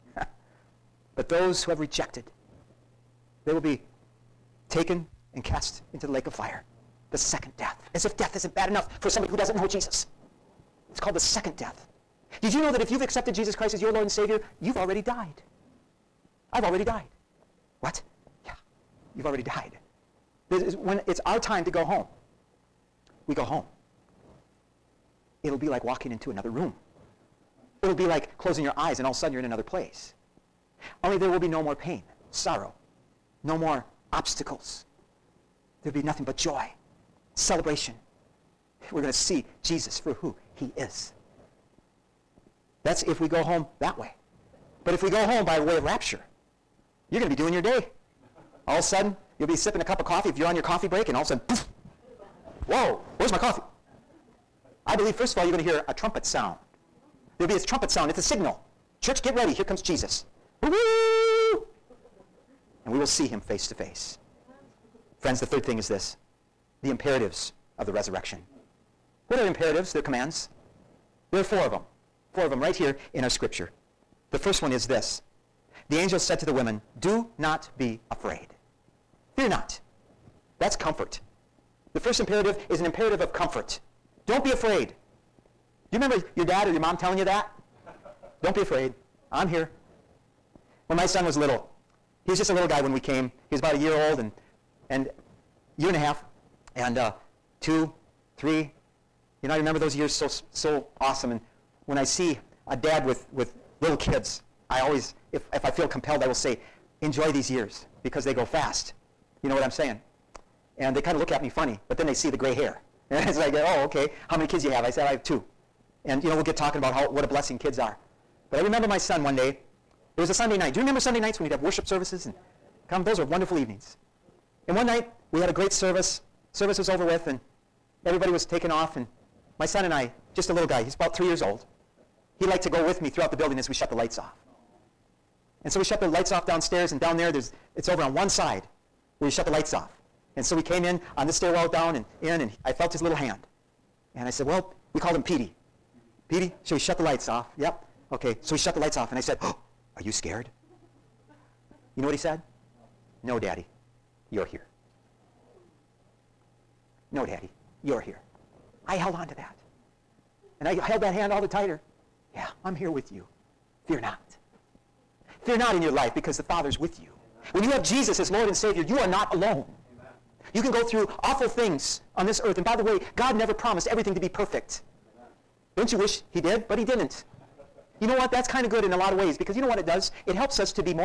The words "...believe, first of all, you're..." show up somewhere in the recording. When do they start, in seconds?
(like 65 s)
54 s.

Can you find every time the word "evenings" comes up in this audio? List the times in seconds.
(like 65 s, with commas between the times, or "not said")
123 s.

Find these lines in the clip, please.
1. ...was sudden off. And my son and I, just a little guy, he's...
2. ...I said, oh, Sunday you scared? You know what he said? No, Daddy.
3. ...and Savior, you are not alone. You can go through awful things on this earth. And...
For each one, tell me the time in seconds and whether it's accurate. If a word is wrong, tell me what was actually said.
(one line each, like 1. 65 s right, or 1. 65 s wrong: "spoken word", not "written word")
1. 128 s wrong: "taken", not "sudden"
2. 149 s wrong: "Are", not "Sunday"
3. 168 s right.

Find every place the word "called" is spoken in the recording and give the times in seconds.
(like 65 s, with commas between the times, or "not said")
10 s, 144 s.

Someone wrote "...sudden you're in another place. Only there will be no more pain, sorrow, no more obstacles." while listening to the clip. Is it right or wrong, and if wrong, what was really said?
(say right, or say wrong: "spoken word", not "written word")
right.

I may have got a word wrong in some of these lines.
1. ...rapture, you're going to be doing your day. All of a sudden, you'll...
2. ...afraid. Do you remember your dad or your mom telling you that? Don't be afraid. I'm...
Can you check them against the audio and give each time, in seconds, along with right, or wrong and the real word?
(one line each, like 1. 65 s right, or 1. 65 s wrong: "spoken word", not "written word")
1. 45 s right
2. 84 s right.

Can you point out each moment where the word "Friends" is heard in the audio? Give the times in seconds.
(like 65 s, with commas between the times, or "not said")
65 s.